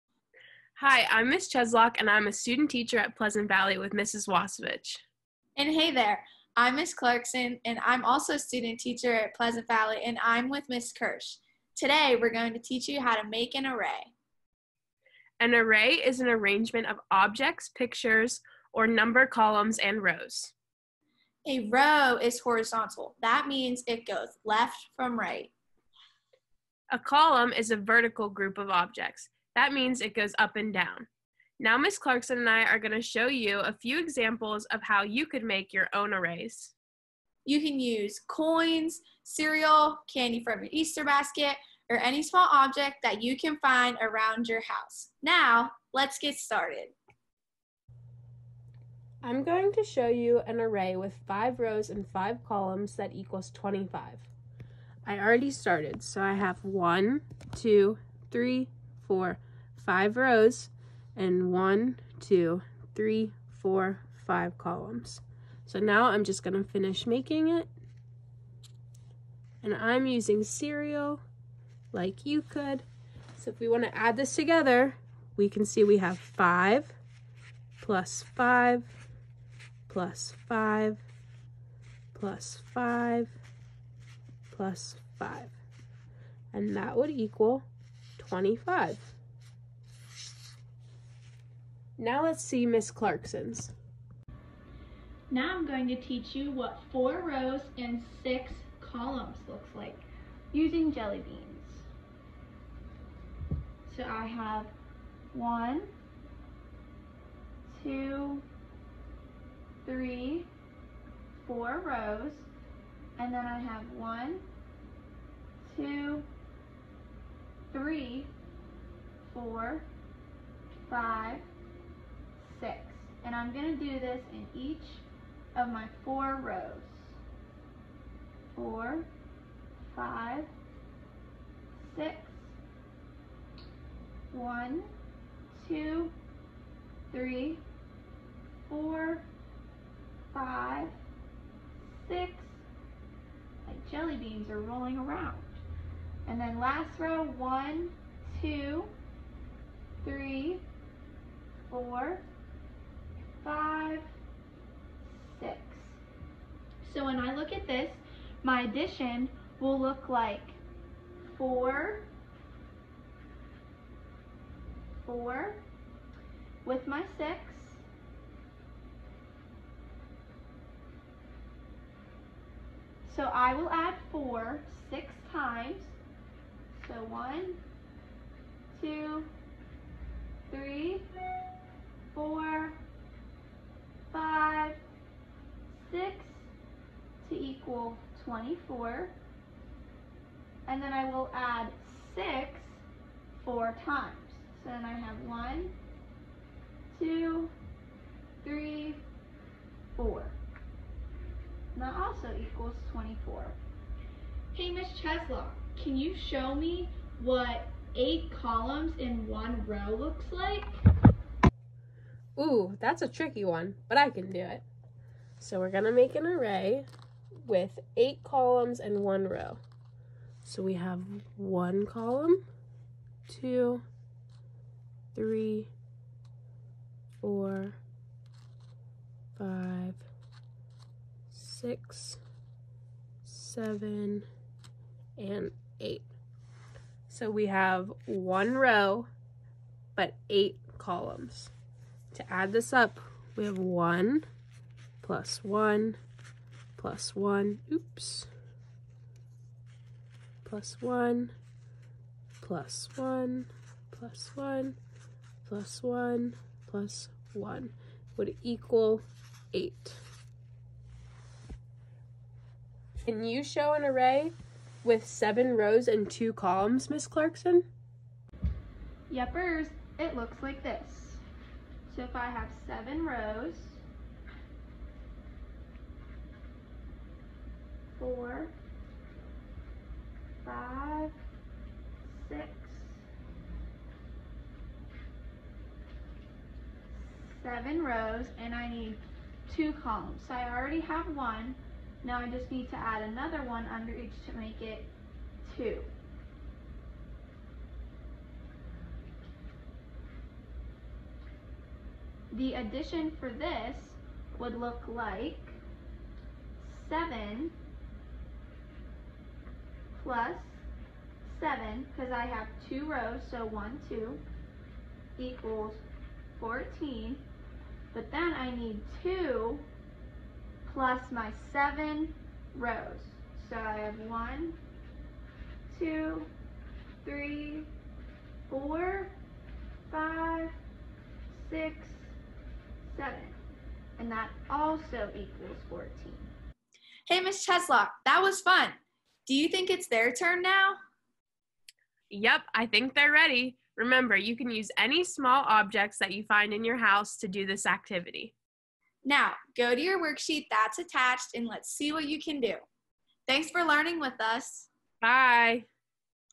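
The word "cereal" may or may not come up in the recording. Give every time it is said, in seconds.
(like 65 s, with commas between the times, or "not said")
39 s, 70 s.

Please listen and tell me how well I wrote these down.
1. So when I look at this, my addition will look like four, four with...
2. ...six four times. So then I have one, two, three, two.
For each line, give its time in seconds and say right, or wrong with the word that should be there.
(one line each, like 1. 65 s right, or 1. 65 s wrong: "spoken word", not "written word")
1. 156 s right
2. 192 s wrong: "four", not "two".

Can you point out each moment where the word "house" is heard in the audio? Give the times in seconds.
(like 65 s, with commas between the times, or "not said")
44 s, 346 s.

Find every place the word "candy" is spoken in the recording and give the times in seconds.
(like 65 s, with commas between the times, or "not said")
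40 s.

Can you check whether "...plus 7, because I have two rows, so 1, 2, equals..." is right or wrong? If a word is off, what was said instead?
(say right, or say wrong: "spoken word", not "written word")
right.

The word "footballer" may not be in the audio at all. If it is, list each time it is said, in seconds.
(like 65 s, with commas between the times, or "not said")
not said.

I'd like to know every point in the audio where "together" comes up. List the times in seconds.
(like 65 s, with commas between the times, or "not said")
74 s.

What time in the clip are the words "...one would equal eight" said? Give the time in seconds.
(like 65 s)
257 s.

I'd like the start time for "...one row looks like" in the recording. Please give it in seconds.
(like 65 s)
209 s.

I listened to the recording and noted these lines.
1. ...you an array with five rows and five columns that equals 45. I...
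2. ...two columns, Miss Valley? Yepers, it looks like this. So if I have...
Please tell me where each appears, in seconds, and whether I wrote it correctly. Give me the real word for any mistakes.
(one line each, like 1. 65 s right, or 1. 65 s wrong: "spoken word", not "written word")
1. 50 s wrong: "25", not "45"
2. 266 s wrong: "Clarkson", not "Valley".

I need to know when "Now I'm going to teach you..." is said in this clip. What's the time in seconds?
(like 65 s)
95 s.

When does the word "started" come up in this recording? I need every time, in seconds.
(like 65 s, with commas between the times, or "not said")
46 s, 55 s.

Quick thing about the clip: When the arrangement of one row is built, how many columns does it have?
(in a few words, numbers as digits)
8.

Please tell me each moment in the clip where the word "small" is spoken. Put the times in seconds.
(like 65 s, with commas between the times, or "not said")
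42 s, 345 s.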